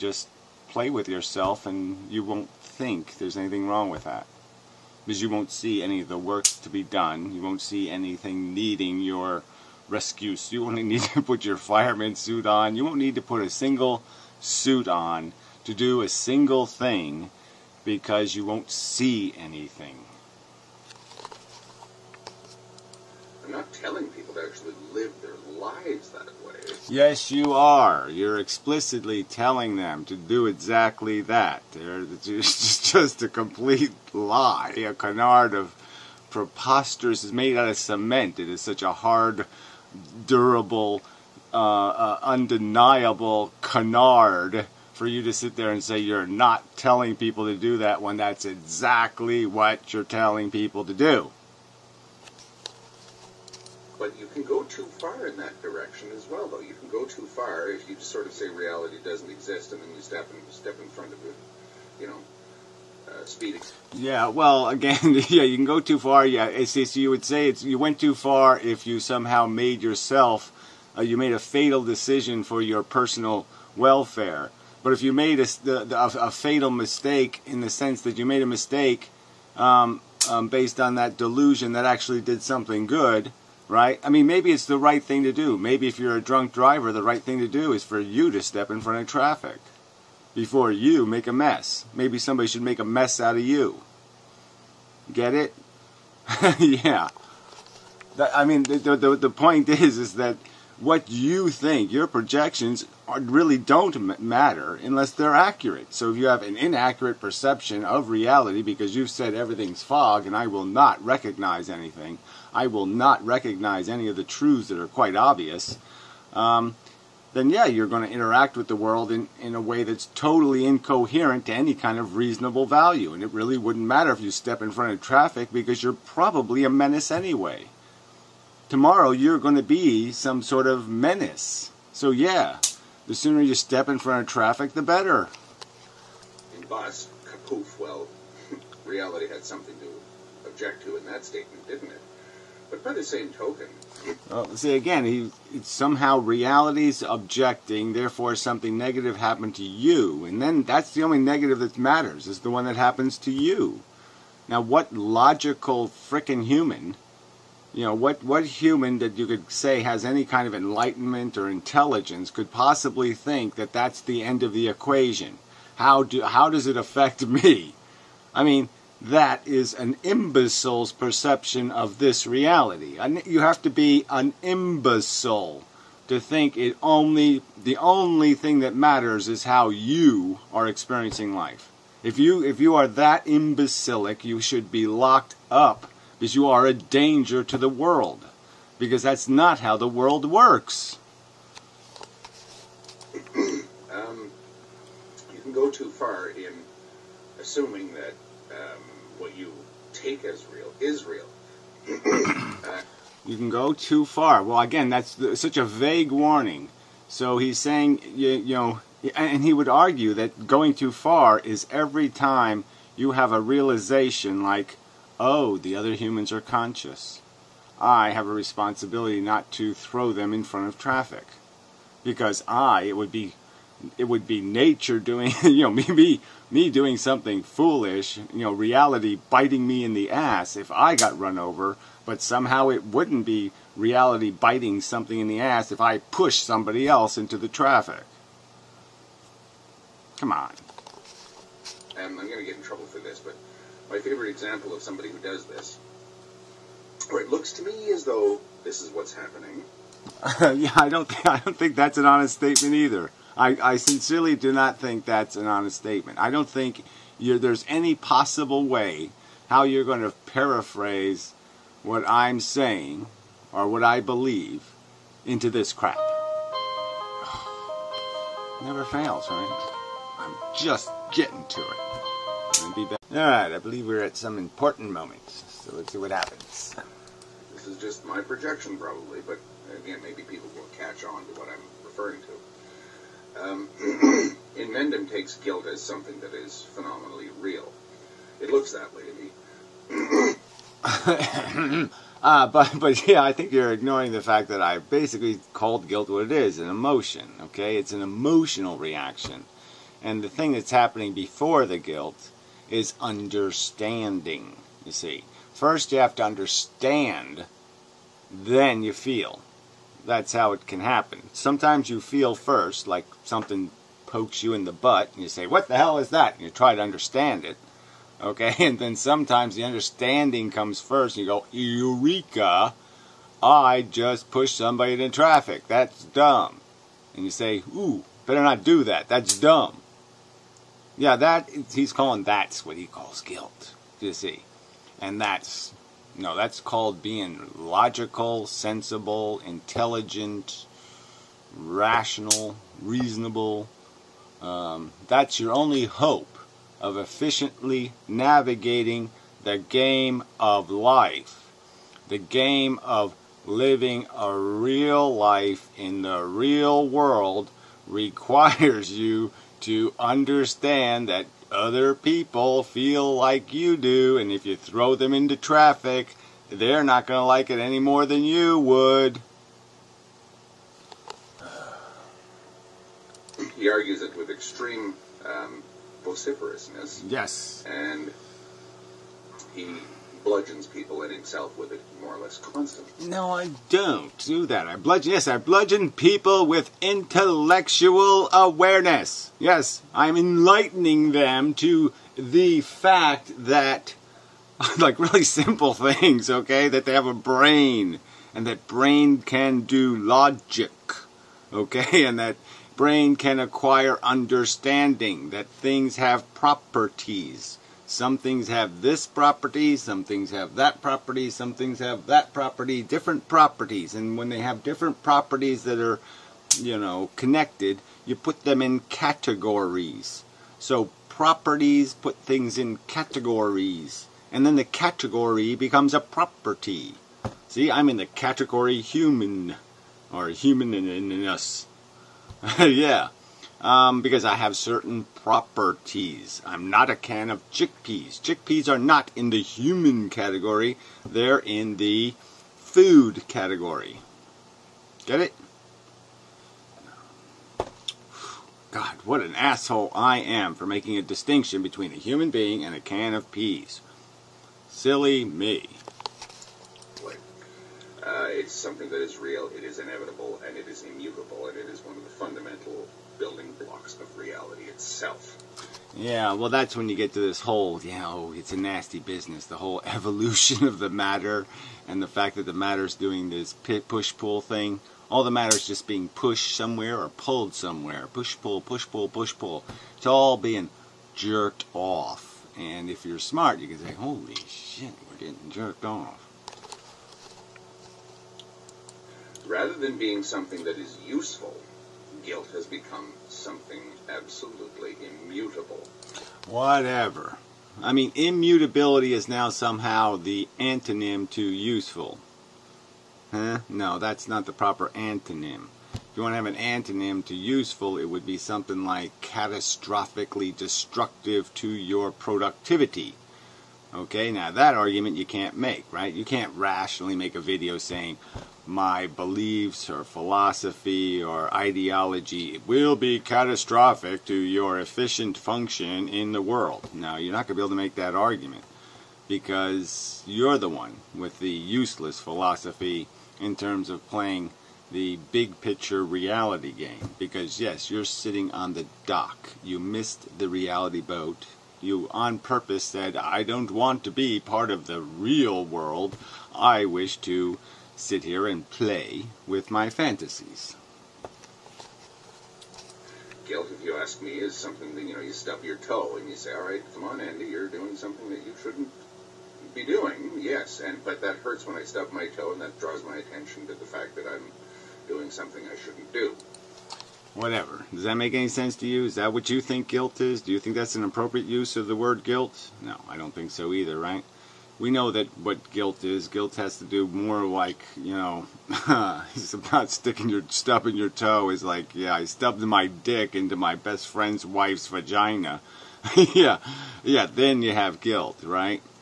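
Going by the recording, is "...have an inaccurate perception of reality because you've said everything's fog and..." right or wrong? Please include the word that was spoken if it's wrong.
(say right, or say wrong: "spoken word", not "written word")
right.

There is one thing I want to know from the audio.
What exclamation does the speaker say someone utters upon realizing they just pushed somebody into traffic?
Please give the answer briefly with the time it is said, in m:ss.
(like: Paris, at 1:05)
Eureka, at 5:21.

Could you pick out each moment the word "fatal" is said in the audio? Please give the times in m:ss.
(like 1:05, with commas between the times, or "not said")
1:11, 1:16.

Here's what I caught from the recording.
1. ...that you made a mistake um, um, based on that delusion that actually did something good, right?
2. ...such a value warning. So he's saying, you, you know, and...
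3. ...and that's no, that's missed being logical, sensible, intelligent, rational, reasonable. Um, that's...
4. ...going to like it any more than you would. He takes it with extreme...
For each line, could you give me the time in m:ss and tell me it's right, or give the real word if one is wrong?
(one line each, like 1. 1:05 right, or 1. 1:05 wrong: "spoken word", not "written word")
1. 1:18 right
2. 3:25 wrong: "vague", not "value"
3. 5:35 wrong: "called", not "missed"
4. 6:07 wrong: "argues", not "takes".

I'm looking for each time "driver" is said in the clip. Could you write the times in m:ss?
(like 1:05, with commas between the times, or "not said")
1:26.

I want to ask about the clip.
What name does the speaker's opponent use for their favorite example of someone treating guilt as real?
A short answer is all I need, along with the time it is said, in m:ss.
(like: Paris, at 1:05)
Mendham, at 4:44.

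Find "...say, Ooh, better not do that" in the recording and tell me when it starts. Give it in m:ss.
5:27.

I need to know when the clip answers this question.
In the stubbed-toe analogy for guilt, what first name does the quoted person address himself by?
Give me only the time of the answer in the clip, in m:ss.
9:17.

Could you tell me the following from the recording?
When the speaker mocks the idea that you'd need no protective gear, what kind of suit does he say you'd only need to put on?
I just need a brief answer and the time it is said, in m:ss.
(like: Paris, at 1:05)
fireman suit, at 0:11.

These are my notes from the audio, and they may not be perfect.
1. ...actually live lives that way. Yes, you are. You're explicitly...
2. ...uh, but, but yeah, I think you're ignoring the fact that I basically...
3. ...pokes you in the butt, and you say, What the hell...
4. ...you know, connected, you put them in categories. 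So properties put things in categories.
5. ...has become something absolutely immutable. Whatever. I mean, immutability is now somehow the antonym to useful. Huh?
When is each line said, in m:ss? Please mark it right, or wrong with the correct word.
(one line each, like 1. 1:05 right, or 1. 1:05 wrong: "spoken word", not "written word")
1. 0:24 right
2. 4:52 right
3. 5:14 right
4. 6:56 right
5. 8:12 right.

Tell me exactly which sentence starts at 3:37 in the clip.
I have a responsibility not to throw them in front of traffic.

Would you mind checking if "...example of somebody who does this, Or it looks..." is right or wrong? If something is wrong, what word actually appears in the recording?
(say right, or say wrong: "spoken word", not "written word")
right.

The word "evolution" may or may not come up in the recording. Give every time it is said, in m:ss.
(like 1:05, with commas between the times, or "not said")
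7:49.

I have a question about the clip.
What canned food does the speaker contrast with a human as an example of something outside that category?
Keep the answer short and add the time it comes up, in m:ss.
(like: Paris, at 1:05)
chickpeas, at 7:16.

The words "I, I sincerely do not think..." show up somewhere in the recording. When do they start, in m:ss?
4:13.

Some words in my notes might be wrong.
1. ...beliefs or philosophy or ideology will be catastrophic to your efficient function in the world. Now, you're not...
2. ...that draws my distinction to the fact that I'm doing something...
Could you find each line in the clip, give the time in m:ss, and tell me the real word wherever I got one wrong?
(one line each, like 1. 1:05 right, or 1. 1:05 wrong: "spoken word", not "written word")
1. 8:39 right
2. 9:22 wrong: "attention", not "distinction".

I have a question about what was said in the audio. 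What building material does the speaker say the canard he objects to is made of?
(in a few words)
cement.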